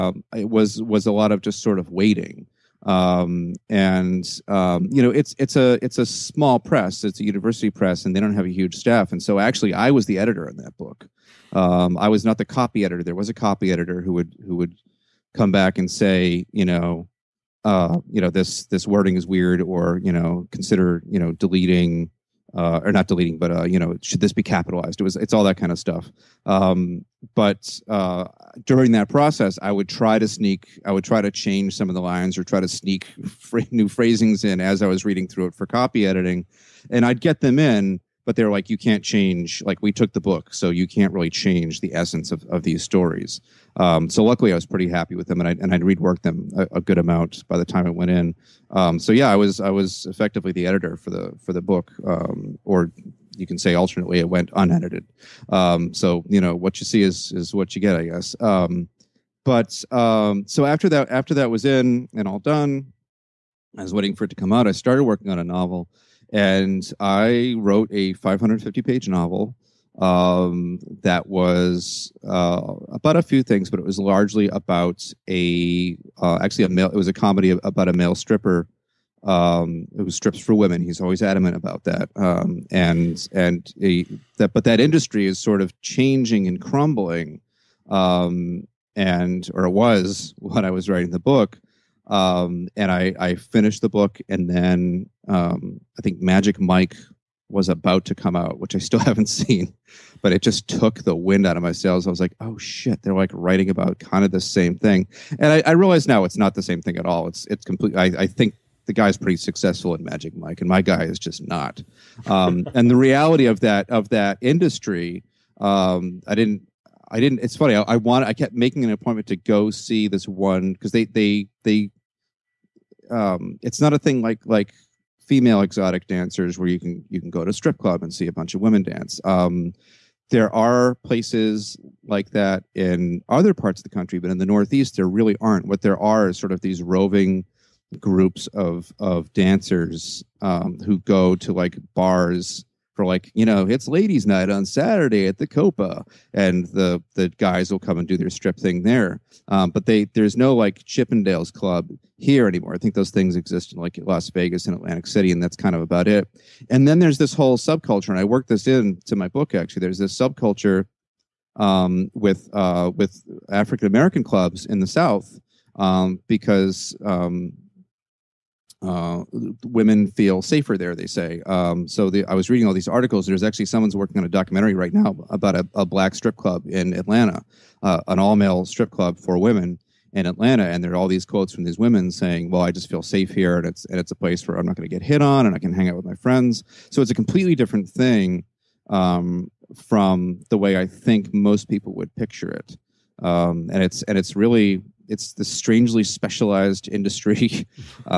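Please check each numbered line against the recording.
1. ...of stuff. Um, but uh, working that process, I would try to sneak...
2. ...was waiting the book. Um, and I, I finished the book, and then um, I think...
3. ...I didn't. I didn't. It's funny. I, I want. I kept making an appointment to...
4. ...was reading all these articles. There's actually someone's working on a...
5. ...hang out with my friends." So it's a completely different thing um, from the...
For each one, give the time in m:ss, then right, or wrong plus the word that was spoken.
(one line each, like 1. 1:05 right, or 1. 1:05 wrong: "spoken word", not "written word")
1. 0:25 wrong: "during", not "working"
2. 1:30 wrong: "writing", not "waiting"
3. 1:56 right
4. 2:52 right
5. 3:05 right.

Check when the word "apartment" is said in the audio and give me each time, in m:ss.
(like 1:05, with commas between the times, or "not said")
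not said.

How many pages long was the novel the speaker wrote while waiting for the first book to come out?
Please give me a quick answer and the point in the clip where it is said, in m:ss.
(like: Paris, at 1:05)
550, at 1:08.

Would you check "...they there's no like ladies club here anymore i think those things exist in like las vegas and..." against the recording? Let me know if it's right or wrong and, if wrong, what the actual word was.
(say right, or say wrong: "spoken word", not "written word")
wrong: "chippendales", not "ladies".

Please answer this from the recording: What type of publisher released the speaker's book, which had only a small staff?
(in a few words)
University press.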